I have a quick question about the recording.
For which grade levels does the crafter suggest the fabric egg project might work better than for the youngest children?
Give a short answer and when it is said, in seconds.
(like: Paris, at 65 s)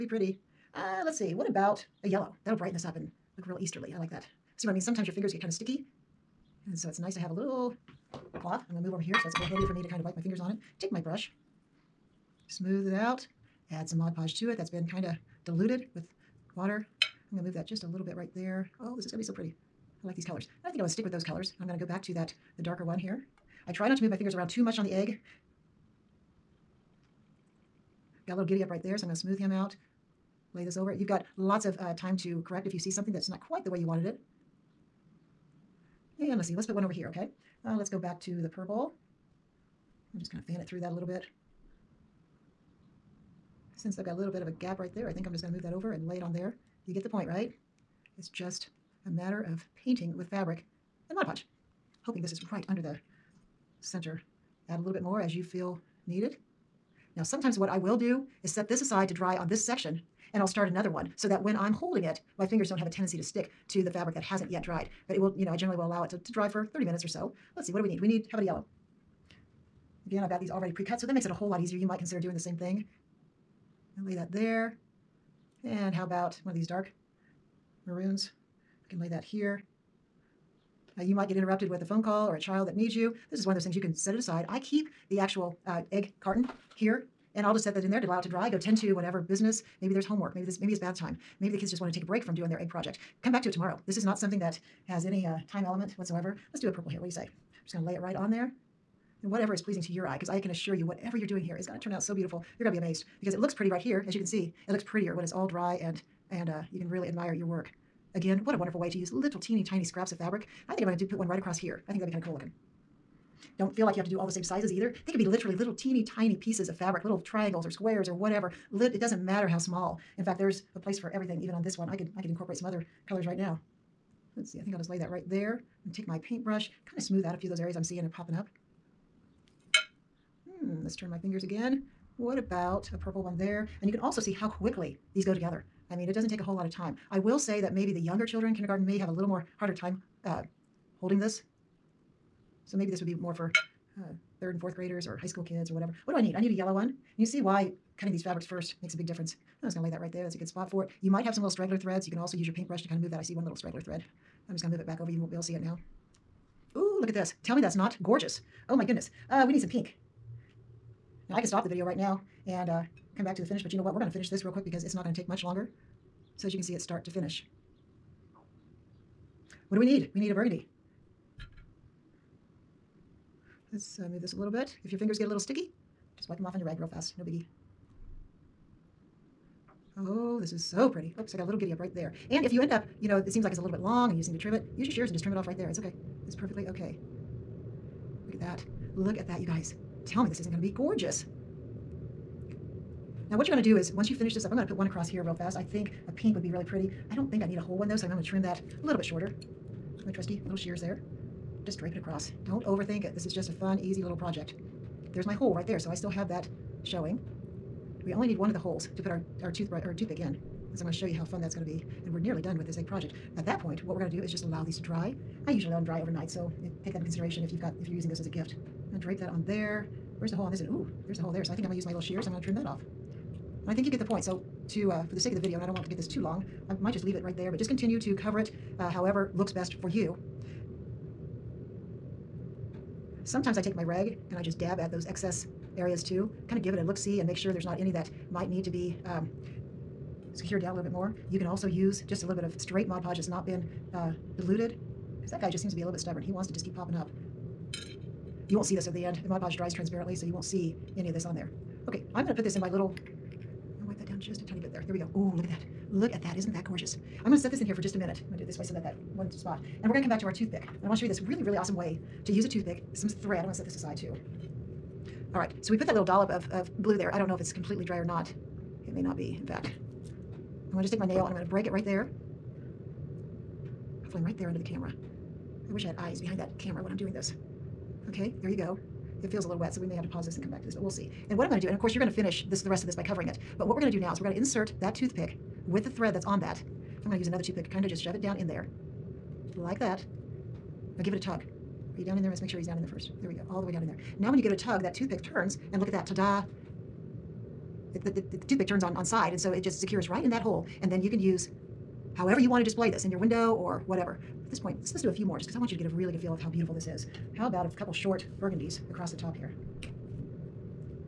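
third and fourth graders, at 144 s.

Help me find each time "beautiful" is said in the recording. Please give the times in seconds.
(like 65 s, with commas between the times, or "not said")
102 s, 306 s.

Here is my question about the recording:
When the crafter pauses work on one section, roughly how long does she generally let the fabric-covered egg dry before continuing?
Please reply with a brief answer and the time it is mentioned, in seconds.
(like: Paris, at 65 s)
30 minutes, at 66 s.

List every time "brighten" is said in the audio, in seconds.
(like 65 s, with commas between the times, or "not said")
2 s.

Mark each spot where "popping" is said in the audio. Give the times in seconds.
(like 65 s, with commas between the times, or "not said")
128 s, 246 s.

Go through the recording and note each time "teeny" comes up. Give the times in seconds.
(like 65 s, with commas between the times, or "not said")
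109 s, 115 s.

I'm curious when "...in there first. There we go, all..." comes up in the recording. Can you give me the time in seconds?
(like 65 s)
292 s.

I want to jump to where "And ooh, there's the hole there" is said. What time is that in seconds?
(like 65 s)
220 s.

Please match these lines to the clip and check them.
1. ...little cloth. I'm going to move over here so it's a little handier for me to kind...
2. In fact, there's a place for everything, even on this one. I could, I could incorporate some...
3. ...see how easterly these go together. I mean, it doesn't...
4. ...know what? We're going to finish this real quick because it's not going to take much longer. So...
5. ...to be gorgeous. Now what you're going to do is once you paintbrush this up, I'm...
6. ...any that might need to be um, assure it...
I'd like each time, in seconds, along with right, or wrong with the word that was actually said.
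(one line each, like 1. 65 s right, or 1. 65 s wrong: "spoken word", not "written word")
1. 7 s right
2. 120 s right
3. 134 s wrong: "quickly", not "easterly"
4. 163 s right
5. 190 s wrong: "finish", not "paintbrush"
6. 237 s wrong: "secure", not "assure".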